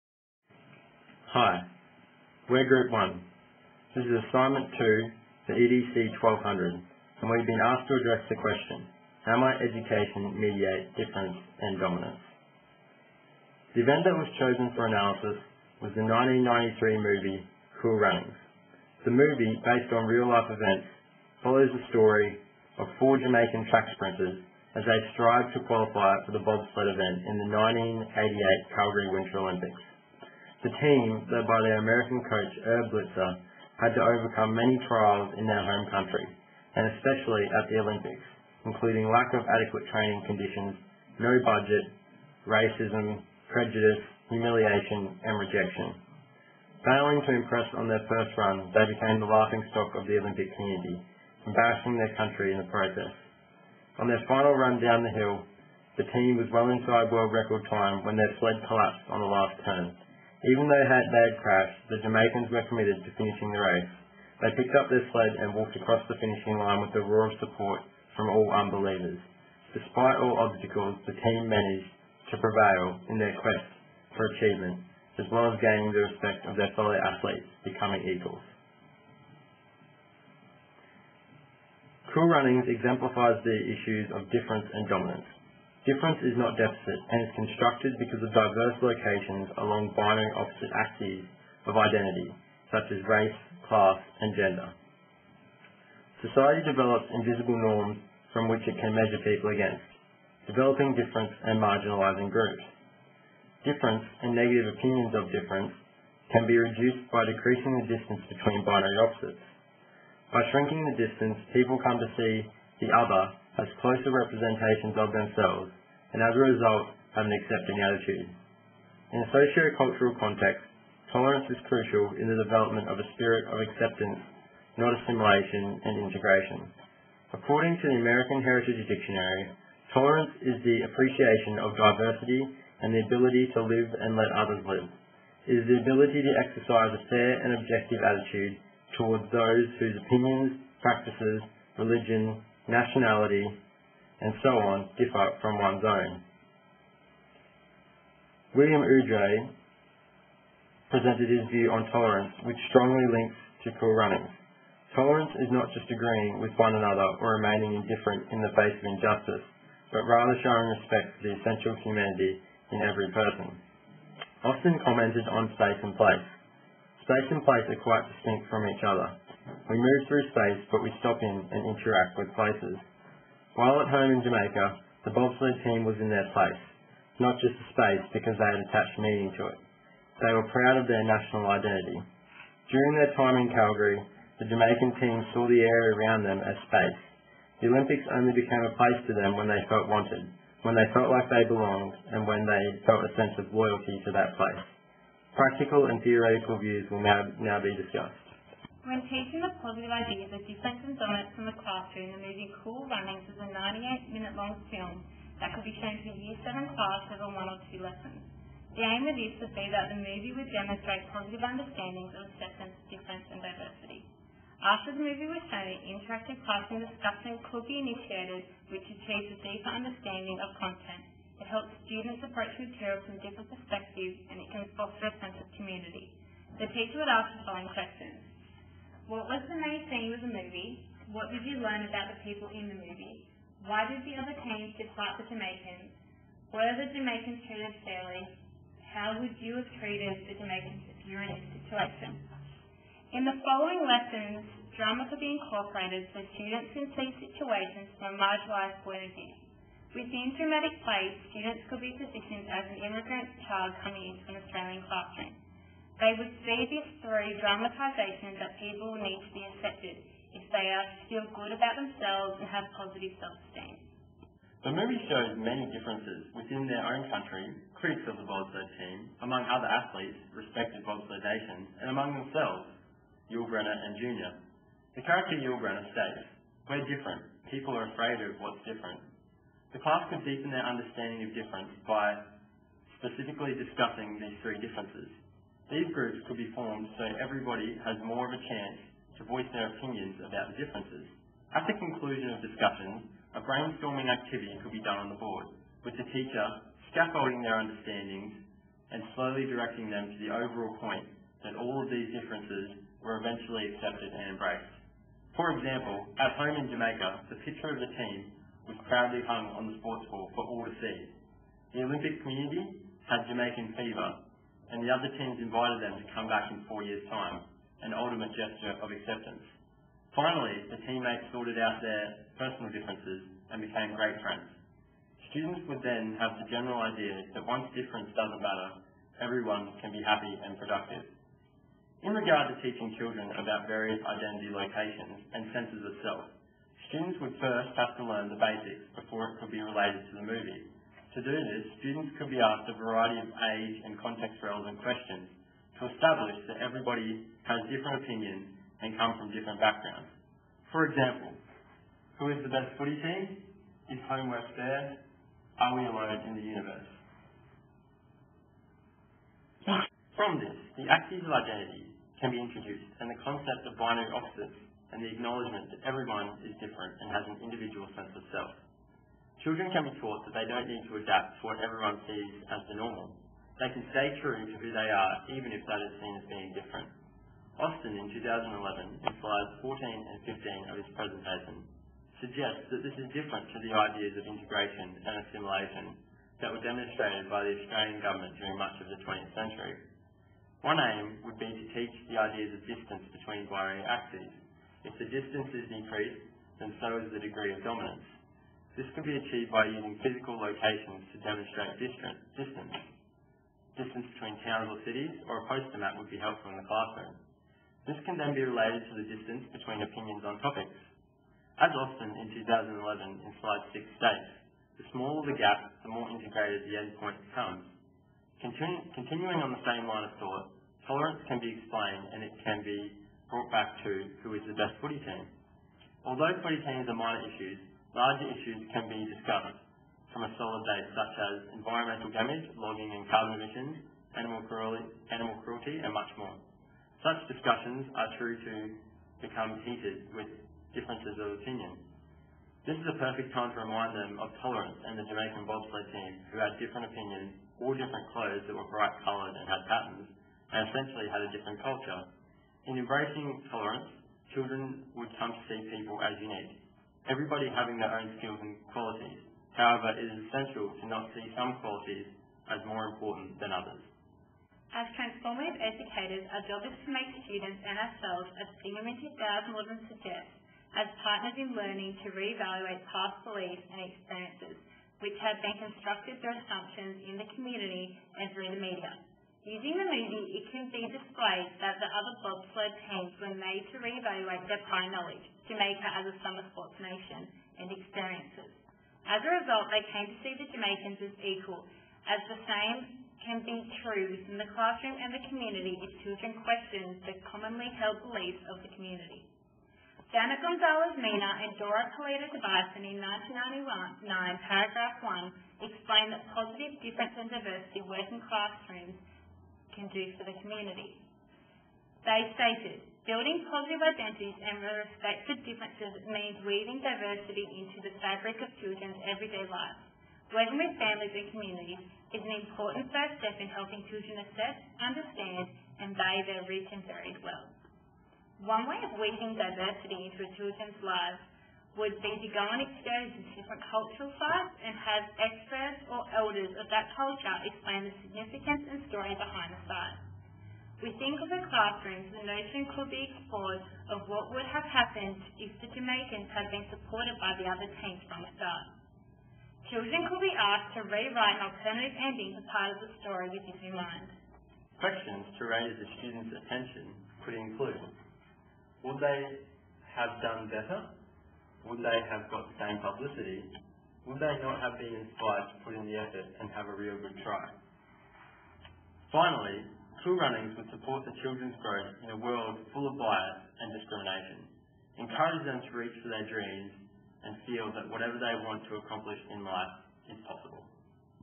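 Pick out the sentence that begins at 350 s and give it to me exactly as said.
For example, who is the best footy team?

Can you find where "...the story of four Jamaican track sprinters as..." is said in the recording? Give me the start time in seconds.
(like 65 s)
21 s.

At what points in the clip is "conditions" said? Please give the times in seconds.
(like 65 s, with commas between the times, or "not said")
40 s.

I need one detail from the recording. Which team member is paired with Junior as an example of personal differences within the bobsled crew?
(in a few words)
Yul Brenner.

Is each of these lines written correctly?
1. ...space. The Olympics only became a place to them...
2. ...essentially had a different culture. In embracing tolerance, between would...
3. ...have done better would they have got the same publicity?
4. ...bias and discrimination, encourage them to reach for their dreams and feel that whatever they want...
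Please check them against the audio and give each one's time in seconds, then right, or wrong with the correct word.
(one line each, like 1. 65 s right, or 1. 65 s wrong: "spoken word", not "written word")
1. 186 s right
2. 450 s wrong: "children", not "between"
3. 559 s right
4. 572 s right.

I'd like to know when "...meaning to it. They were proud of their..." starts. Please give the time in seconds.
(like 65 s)
178 s.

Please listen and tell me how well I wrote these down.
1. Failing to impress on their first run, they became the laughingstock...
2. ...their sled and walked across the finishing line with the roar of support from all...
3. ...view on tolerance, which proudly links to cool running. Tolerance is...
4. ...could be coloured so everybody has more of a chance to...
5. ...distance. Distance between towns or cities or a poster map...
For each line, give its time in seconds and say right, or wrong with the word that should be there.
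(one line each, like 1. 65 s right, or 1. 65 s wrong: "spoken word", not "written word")
1. 46 s right
2. 64 s right
3. 151 s wrong: "strongly", not "proudly"
4. 286 s wrong: "formed", not "coloured"
5. 401 s right.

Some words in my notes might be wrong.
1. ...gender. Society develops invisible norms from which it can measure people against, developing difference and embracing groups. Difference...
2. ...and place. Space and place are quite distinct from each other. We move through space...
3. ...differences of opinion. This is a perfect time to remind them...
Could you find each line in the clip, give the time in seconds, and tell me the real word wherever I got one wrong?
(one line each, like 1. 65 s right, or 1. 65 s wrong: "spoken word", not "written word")
1. 94 s wrong: "marginalizing", not "embracing"
2. 165 s right
3. 440 s right.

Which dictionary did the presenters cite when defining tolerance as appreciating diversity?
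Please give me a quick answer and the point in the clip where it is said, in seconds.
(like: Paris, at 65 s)
American Heritage Dictionary, at 127 s.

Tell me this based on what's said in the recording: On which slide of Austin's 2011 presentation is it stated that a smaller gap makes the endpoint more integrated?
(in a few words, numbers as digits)
6.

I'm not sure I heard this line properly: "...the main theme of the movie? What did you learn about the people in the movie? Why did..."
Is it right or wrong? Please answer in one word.
right.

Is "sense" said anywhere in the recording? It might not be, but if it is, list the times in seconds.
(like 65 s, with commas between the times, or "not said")
193 s, 225 s, 335 s, 367 s.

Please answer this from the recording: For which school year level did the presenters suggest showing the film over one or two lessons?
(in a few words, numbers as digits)
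Year 7.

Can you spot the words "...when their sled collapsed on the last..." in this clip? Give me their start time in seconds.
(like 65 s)
58 s.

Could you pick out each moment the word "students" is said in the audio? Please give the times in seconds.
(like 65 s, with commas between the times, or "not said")
221 s, 246 s, 251 s, 325 s, 336 s, 341 s, 467 s, 556 s.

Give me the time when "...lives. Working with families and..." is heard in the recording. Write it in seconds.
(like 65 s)
519 s.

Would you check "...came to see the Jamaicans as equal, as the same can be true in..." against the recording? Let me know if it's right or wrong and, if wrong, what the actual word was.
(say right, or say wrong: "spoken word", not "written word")
right.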